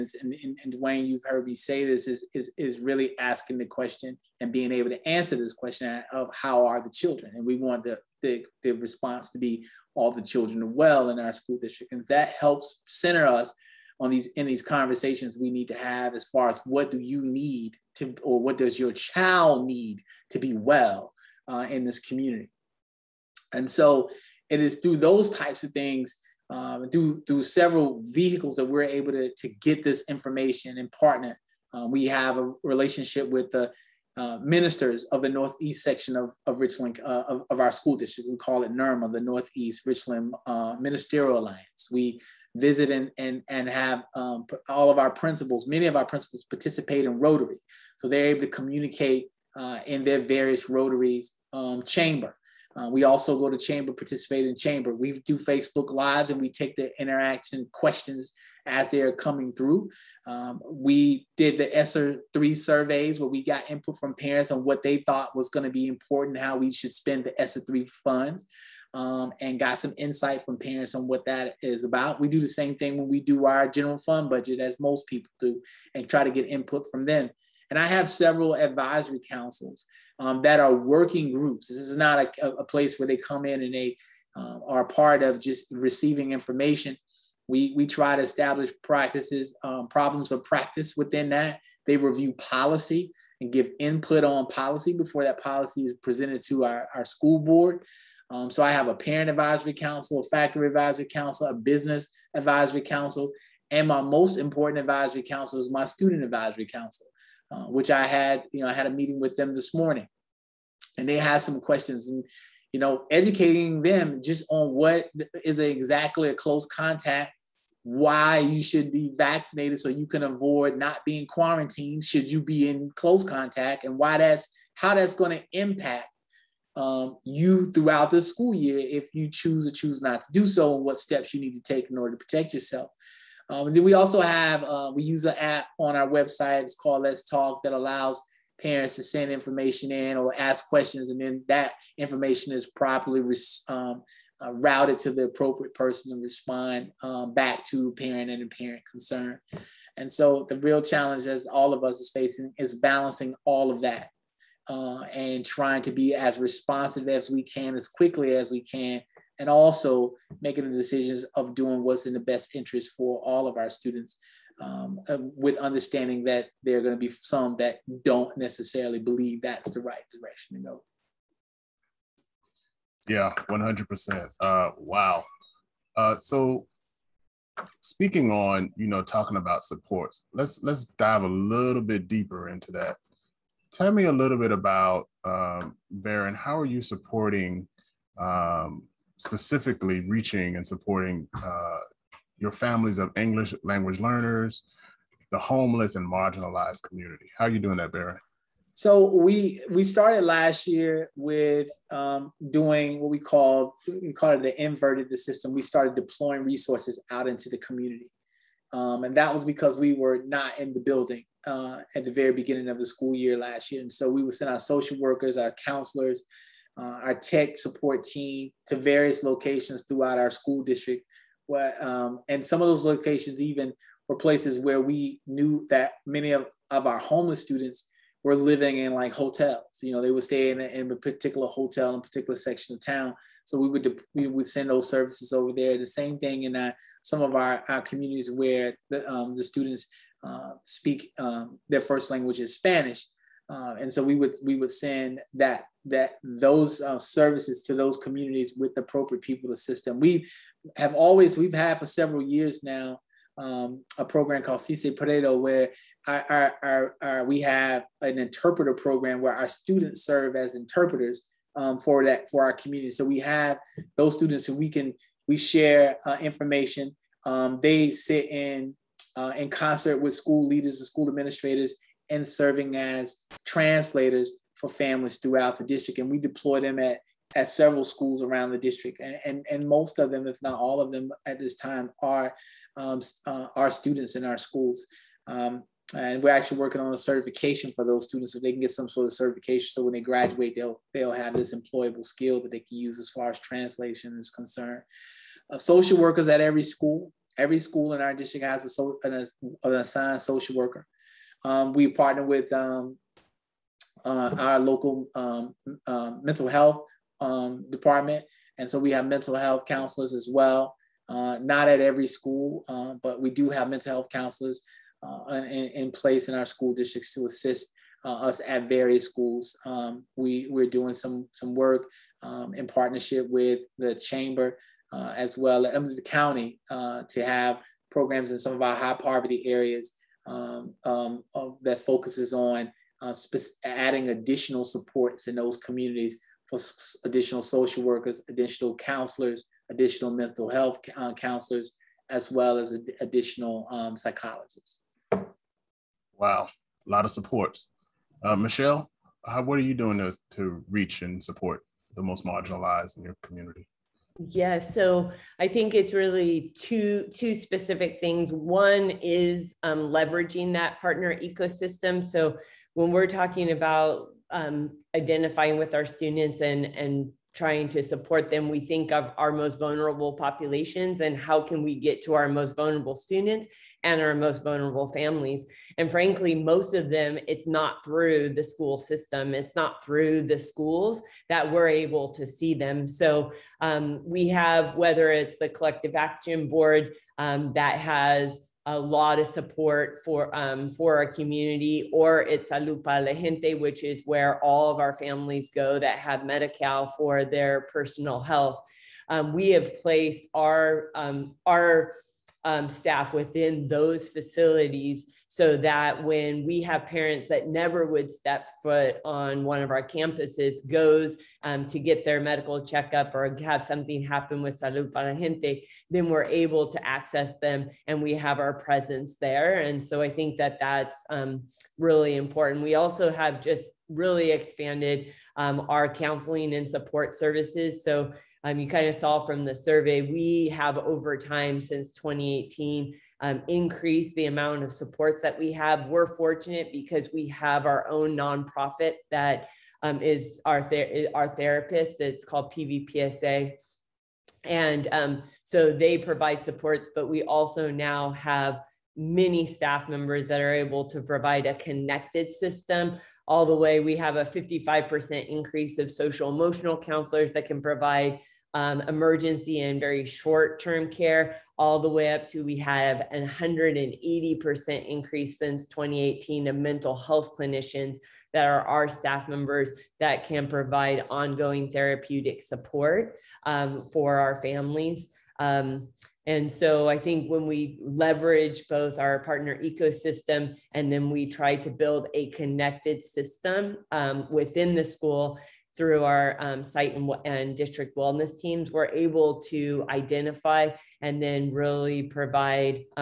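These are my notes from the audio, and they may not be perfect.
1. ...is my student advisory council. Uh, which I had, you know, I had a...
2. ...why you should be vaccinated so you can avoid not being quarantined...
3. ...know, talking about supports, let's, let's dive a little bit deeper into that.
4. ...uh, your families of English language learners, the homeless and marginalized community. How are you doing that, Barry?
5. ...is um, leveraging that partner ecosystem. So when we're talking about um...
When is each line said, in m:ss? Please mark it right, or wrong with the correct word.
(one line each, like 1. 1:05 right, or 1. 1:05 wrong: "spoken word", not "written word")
1. 1:45 right
2. 1:57 right
3. 2:58 right
4. 3:11 right
5. 5:59 right.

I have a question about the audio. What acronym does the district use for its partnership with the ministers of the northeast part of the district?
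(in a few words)
NERMA.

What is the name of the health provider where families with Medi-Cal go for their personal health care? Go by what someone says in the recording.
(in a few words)
Salud Para La Gente.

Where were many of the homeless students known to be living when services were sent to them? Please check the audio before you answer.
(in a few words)
hotels.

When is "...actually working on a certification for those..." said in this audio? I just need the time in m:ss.
4:46.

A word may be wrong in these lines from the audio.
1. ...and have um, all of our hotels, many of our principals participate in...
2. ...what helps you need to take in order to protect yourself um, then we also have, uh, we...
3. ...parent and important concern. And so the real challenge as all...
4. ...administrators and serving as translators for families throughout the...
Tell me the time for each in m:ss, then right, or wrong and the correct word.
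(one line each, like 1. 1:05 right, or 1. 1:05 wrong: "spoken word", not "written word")
1. 0:43 wrong: "principals", not "hotels"
2. 2:10 wrong: "steps", not "helps"
3. 2:27 wrong: "parent", not "important"
4. 4:31 right.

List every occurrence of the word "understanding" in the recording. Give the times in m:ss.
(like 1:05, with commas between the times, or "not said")
2:45.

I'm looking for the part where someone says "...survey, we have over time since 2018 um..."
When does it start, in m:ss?
7:09.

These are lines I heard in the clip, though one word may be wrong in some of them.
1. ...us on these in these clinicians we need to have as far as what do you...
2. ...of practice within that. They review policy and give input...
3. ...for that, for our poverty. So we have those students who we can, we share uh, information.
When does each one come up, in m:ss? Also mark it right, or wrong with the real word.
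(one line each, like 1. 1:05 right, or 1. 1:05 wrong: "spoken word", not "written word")
1. 0:13 wrong: "conversations", not "clinicians"
2. 1:30 right
3. 4:21 wrong: "community", not "poverty".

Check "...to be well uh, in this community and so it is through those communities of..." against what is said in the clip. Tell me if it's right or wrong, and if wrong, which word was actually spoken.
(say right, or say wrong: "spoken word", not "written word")
wrong: "types", not "communities".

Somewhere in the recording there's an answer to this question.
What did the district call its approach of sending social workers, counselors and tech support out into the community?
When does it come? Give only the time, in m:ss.
3:24.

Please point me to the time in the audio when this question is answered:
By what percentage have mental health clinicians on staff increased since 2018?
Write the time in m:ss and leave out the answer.
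7:43.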